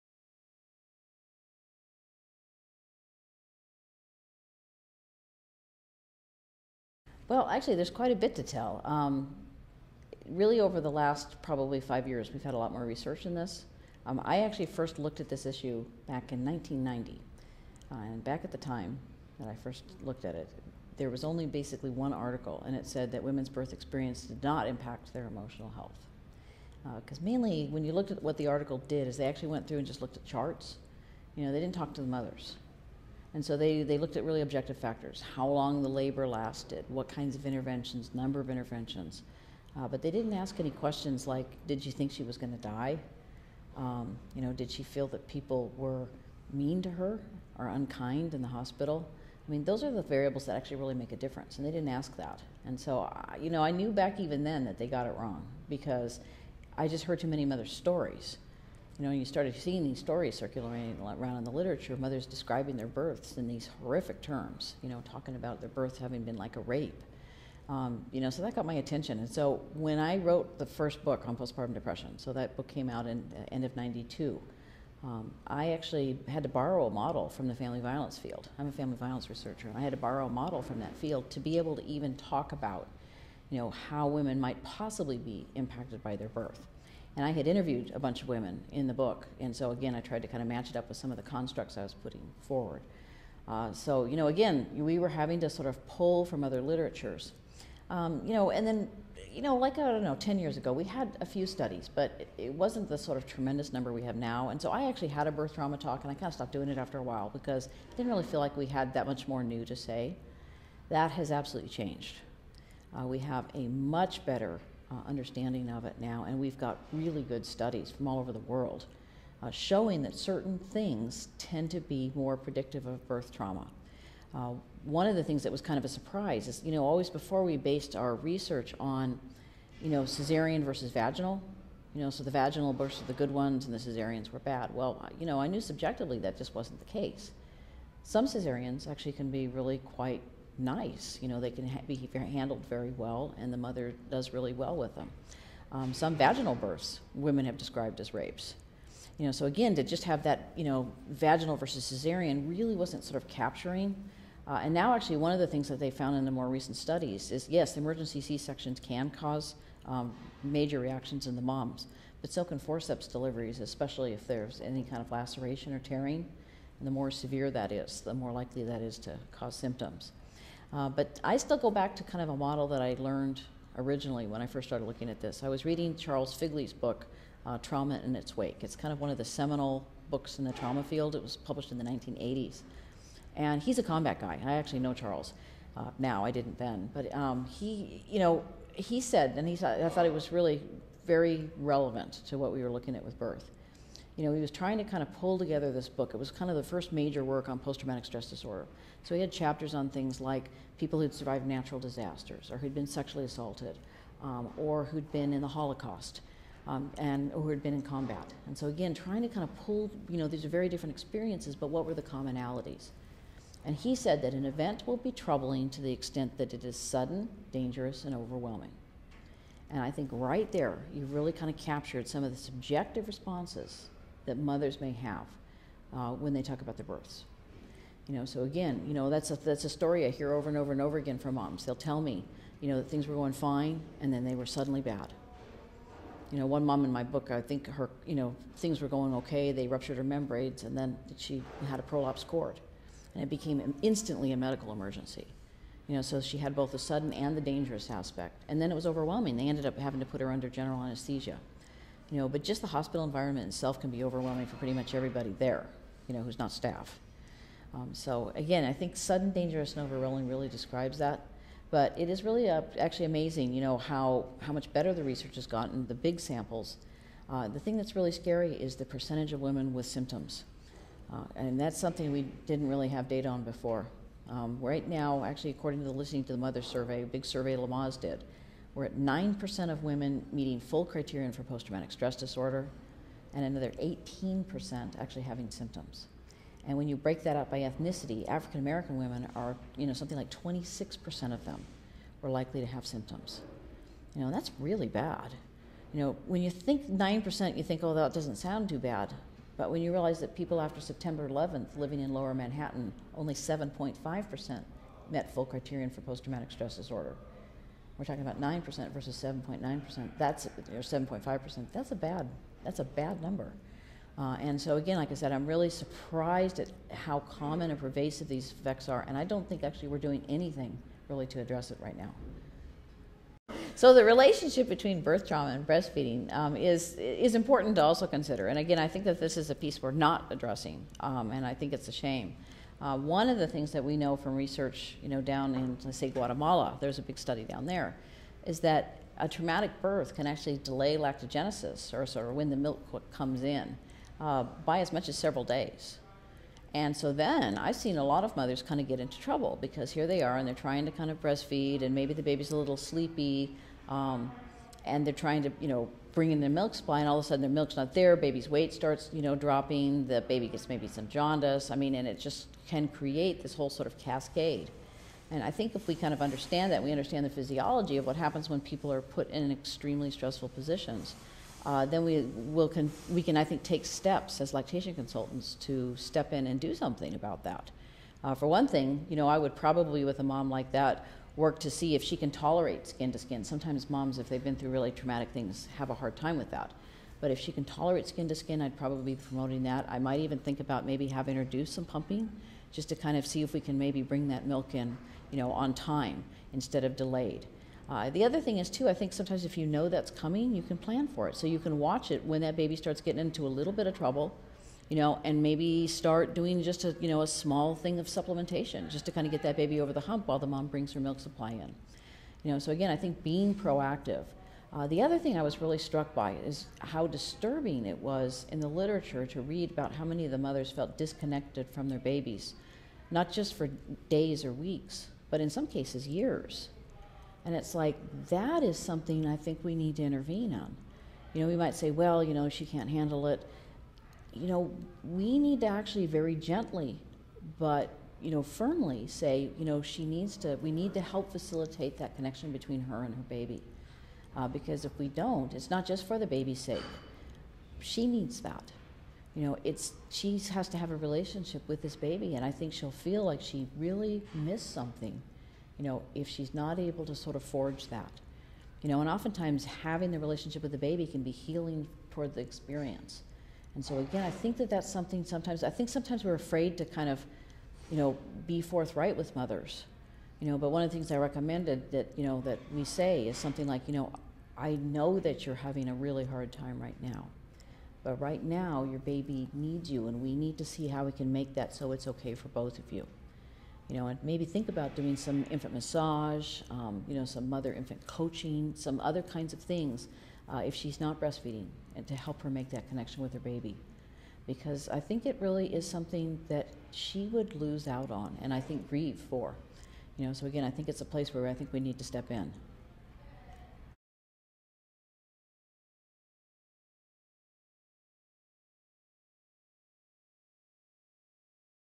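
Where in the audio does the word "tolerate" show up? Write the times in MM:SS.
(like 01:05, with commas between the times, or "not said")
06:22, 06:27.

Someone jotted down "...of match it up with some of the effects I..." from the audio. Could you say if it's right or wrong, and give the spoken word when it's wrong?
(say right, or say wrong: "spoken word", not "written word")
wrong: "constructs", not "effects".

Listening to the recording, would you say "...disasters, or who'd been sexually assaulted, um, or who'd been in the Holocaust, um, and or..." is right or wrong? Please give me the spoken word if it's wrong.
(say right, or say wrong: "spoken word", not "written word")
right.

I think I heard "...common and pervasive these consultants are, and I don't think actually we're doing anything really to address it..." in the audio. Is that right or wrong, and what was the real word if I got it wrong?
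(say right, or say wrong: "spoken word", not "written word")
wrong: "effects", not "consultants".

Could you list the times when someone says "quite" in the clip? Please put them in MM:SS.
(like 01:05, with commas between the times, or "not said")
00:07, 02:19.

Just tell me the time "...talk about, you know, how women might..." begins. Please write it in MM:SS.
01:22.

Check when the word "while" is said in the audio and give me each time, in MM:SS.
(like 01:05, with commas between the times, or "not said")
01:47, 06:50.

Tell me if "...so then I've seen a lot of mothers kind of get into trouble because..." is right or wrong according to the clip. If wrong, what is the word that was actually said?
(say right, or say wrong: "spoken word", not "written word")
right.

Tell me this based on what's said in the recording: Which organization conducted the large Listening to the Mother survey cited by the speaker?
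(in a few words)
Lamaze.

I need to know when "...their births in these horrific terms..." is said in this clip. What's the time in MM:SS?
01:02.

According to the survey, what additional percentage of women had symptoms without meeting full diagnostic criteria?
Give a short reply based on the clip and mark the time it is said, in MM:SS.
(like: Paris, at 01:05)
18%, at 04:43.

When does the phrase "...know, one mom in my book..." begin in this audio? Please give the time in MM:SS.
03:56.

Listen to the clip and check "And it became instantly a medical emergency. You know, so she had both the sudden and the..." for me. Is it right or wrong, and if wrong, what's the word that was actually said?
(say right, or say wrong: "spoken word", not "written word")
right.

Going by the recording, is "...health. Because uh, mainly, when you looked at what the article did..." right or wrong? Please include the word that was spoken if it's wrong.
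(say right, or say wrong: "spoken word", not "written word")
right.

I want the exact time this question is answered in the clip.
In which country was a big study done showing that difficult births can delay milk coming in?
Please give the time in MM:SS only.
05:36.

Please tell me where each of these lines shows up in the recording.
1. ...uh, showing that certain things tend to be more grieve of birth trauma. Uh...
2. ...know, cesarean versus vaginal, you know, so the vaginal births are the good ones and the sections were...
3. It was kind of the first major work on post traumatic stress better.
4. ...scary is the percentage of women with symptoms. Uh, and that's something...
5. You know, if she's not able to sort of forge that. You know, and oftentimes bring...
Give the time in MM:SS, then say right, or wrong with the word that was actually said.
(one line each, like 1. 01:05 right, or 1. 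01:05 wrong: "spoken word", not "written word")
1. 01:59 wrong: "predictive", not "grieve"
2. 02:09 wrong: "cesareans", not "sections"
3. 03:16 wrong: "disorder", not "better"
4. 04:28 right
5. 07:35 wrong: "having", not "bring".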